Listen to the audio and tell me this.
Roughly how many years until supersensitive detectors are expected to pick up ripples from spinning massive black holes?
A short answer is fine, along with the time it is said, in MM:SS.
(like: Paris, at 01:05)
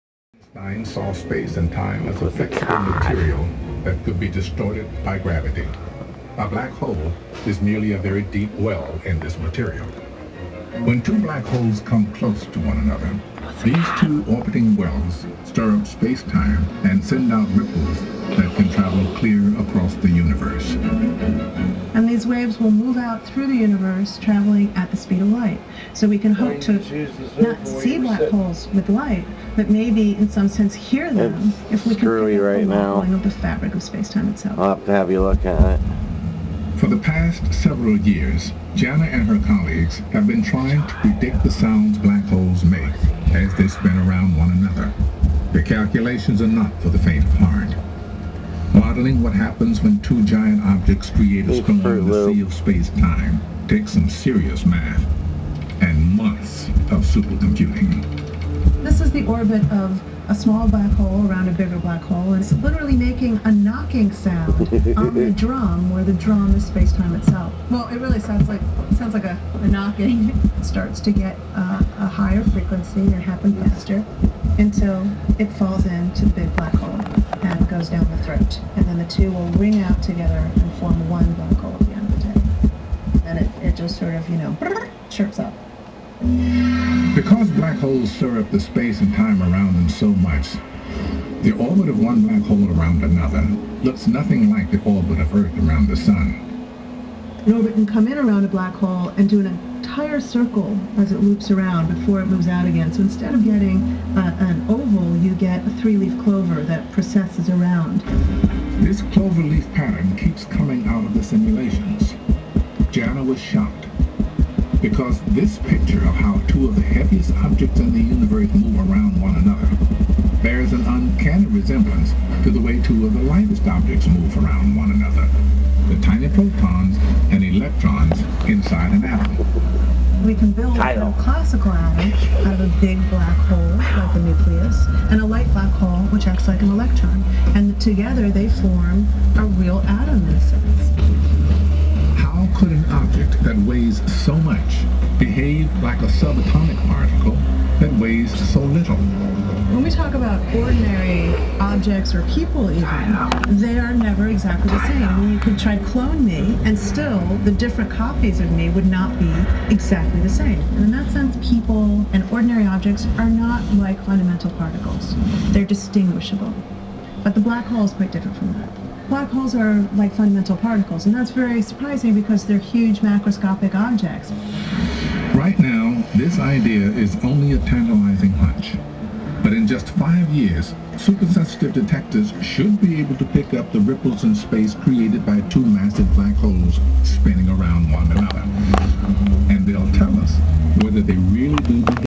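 5 years, at 02:59.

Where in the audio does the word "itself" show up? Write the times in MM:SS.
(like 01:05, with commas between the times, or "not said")
00:34, 01:07.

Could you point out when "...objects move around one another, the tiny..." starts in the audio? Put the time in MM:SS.
02:03.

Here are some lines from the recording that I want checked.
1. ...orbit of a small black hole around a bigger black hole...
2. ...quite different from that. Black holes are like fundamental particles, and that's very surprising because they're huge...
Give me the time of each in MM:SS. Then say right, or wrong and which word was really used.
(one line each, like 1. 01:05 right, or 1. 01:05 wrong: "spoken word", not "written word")
1. 00:59 right
2. 02:47 right.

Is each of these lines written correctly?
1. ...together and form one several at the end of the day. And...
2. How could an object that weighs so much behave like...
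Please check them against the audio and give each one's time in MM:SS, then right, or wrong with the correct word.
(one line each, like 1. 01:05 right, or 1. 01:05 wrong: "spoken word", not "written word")
1. 01:20 wrong: "vocal", not "several"
2. 02:22 right.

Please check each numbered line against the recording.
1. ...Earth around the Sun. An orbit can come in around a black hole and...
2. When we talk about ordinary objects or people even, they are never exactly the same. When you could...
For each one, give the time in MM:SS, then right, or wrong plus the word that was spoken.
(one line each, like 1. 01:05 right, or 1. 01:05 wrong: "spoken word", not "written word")
1. 01:35 right
2. 02:29 right.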